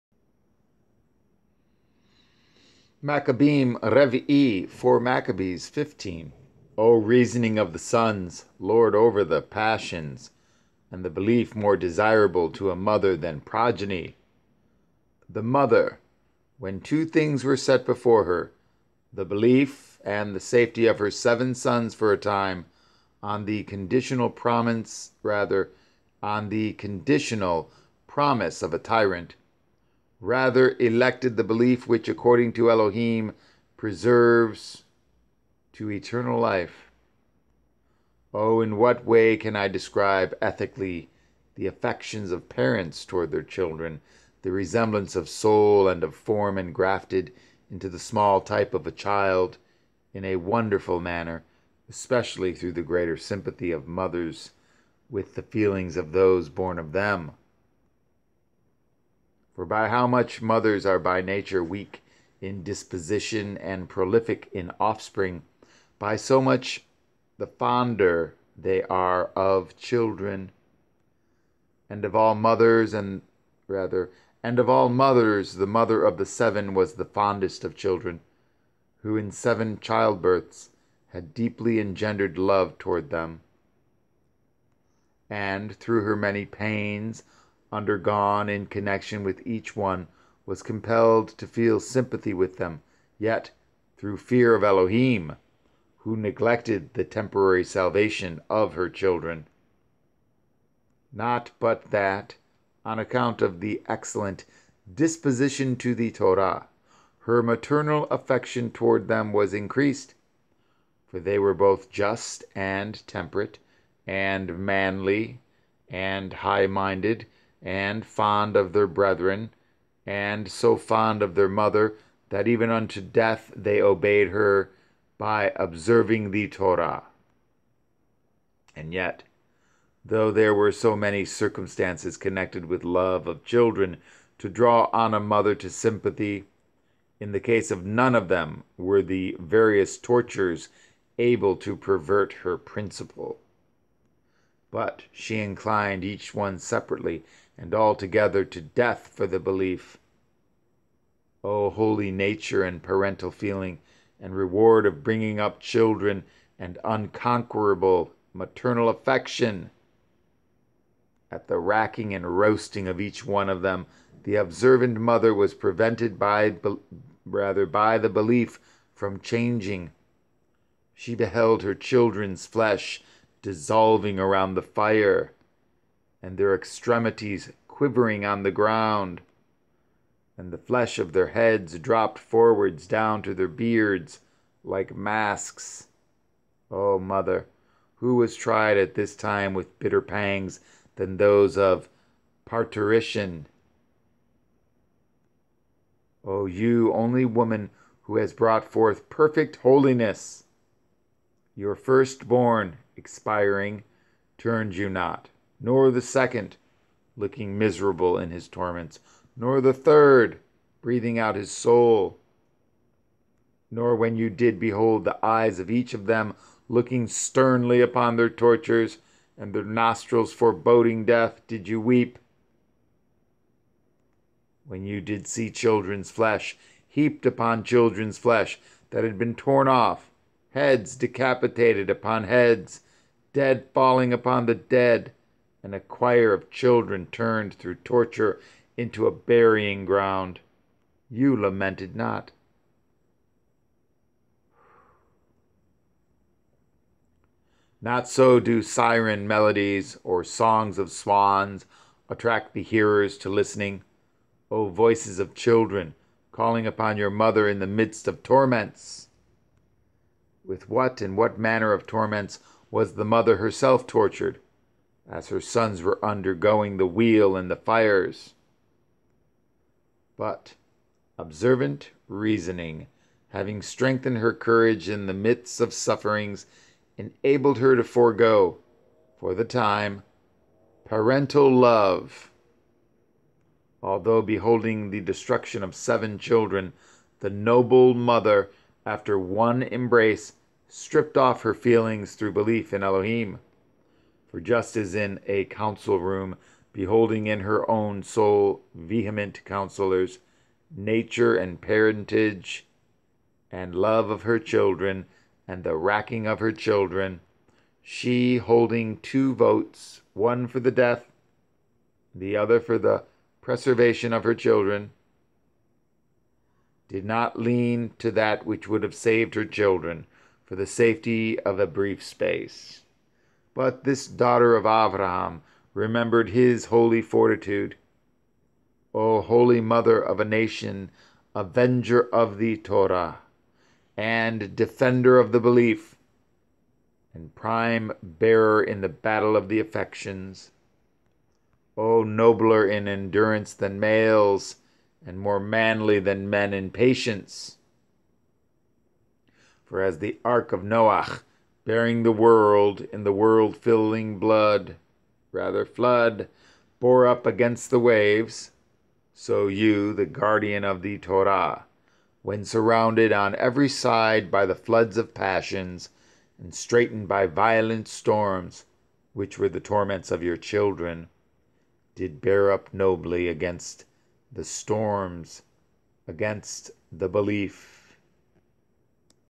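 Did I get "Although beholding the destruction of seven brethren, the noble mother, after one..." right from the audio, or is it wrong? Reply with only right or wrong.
wrong.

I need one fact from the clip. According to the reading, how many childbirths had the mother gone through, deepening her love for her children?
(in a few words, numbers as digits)
7.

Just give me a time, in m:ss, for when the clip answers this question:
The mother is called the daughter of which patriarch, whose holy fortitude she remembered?
5:24.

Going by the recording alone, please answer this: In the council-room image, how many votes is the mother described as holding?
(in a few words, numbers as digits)
2.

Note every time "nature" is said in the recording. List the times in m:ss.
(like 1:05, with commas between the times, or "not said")
1:01, 2:32, 5:00.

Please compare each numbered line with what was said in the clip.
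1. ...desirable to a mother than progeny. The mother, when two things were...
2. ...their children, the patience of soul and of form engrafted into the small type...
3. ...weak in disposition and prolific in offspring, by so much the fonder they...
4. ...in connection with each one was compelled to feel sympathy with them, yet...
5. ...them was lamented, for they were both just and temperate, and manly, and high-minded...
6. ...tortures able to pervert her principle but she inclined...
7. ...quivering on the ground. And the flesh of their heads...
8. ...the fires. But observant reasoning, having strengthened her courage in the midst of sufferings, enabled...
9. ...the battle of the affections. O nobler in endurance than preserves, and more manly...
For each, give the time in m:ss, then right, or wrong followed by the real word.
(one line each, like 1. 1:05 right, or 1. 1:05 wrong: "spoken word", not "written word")
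1. 0:11 right
2. 0:43 wrong: "resemblance", not "patience"
3. 1:01 right
4. 1:28 right
5. 1:49 wrong: "increased", not "lamented"
6. 2:19 right
7. 2:57 right
8. 4:27 right
9. 5:38 wrong: "males", not "preserves".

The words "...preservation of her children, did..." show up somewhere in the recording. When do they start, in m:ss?
5:13.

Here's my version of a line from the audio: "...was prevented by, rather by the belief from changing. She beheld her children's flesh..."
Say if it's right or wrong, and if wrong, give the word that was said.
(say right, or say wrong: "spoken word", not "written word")
right.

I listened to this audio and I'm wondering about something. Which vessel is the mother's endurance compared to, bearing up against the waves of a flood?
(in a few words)
the ark of Noah.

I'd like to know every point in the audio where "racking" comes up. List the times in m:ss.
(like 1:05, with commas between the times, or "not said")
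2:41, 5:05.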